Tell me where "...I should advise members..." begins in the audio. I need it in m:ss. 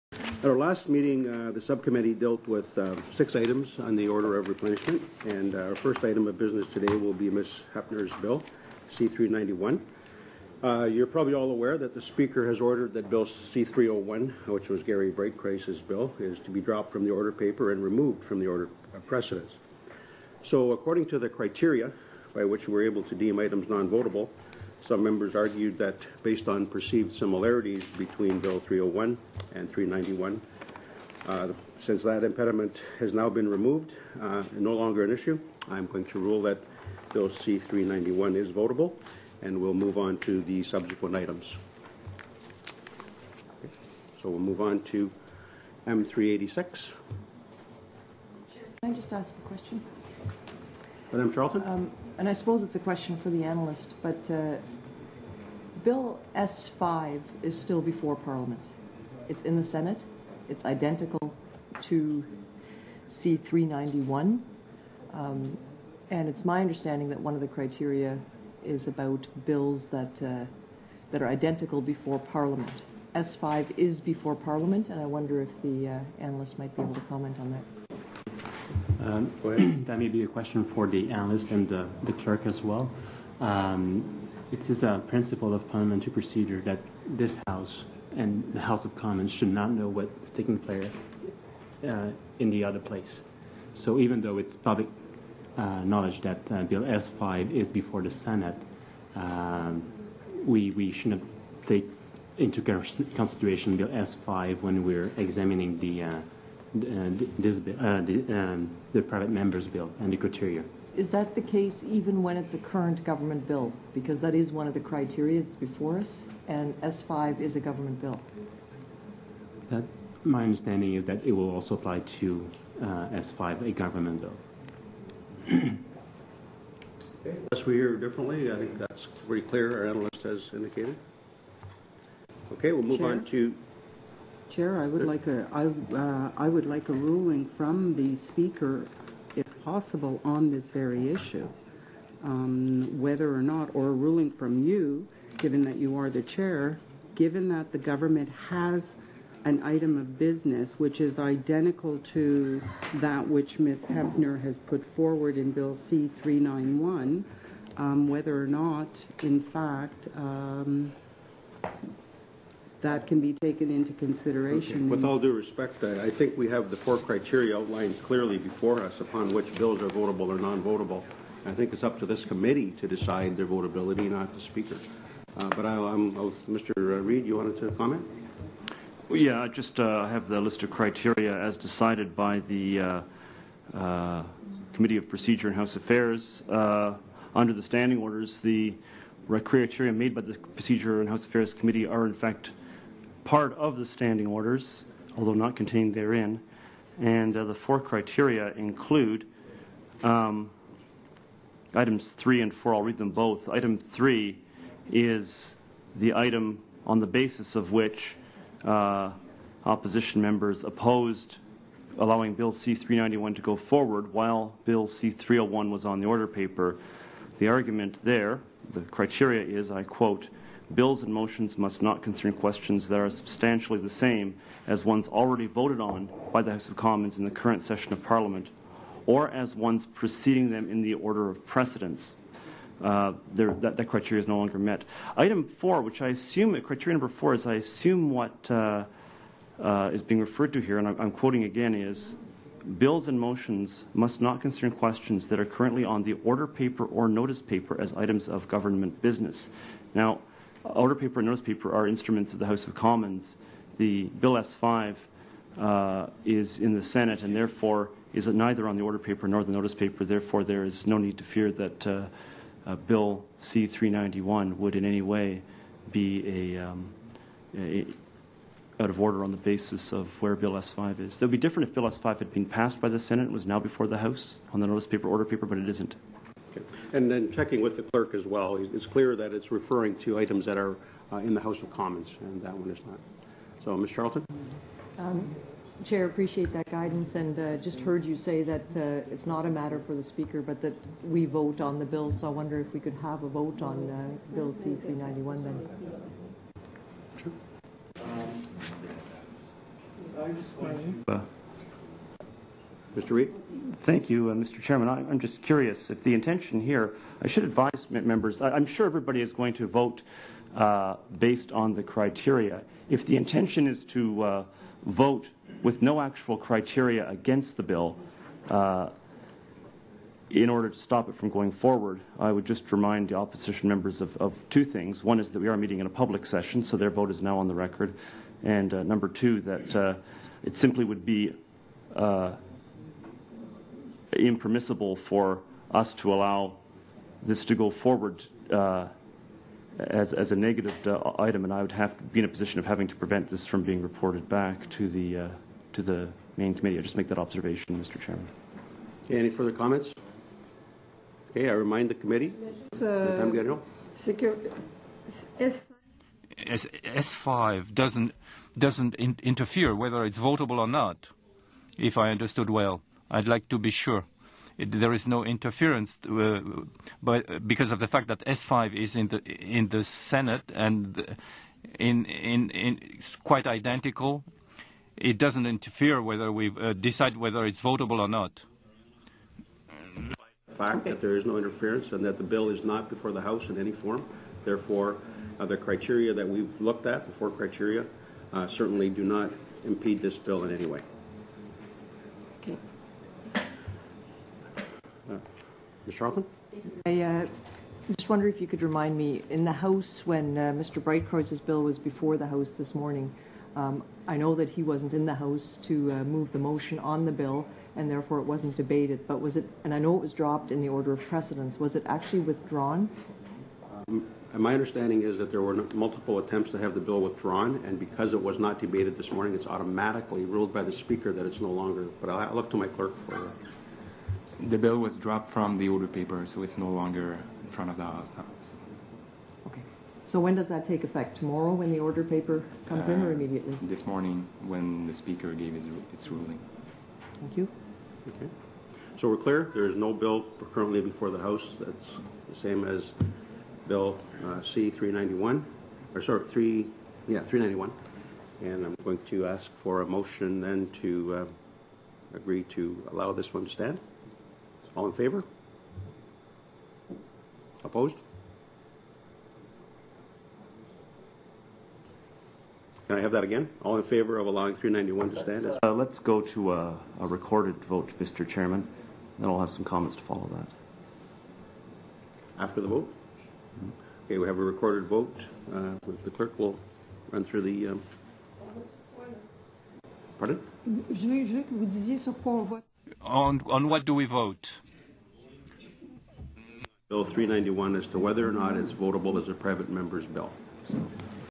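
5:07.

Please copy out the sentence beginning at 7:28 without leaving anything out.
And I'm going to ask for a motion then to uh, agree to allow this one to stand.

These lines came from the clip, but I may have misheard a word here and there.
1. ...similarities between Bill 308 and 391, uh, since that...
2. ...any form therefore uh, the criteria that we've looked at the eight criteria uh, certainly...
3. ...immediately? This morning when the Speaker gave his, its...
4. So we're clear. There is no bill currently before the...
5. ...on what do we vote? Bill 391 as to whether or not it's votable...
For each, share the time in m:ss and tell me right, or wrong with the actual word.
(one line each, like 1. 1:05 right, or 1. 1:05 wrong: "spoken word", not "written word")
1. 0:27 wrong: "301", not "308"
2. 6:23 wrong: "four", not "eight"
3. 7:13 right
4. 7:18 right
5. 8:03 right.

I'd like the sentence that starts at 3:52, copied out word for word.
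Uh, that, that, criteria is no longer met.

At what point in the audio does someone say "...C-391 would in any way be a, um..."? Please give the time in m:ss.
4:23.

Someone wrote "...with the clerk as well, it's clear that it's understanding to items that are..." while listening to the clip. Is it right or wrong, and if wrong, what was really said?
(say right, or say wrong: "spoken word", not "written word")
wrong: "referring", not "understanding".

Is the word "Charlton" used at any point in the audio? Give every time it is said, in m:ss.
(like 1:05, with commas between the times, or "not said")
0:51, 4:43, 6:35.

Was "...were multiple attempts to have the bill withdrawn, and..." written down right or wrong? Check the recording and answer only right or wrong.
right.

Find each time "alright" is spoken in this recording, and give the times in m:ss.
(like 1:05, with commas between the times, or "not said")
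not said.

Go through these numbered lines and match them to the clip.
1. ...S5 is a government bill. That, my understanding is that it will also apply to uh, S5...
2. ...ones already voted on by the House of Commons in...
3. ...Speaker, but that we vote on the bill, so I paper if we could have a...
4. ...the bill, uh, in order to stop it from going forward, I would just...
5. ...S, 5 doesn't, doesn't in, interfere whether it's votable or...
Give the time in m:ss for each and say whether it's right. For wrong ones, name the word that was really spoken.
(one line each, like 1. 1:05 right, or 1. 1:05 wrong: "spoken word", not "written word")
1. 1:56 right
2. 3:44 right
3. 4:50 wrong: "wonder", not "paper"
4. 5:17 right
5. 5:56 right.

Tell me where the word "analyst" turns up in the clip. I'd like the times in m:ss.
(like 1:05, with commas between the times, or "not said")
0:53, 1:16, 1:21, 2:09.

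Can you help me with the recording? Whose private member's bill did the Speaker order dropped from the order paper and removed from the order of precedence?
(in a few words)
Garry Breitkreuz.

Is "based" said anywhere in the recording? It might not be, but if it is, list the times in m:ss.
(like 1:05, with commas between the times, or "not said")
0:26, 5:11.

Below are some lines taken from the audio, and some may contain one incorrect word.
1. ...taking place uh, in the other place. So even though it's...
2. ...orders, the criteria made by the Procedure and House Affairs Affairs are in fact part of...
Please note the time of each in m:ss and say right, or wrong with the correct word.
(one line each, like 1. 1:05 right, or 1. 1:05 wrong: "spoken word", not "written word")
1. 1:30 right
2. 3:07 wrong: "Committee", not "Affairs".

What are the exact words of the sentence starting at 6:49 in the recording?
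But was it, and I know it was dropped in the order of precedence, was it actually withdrawn?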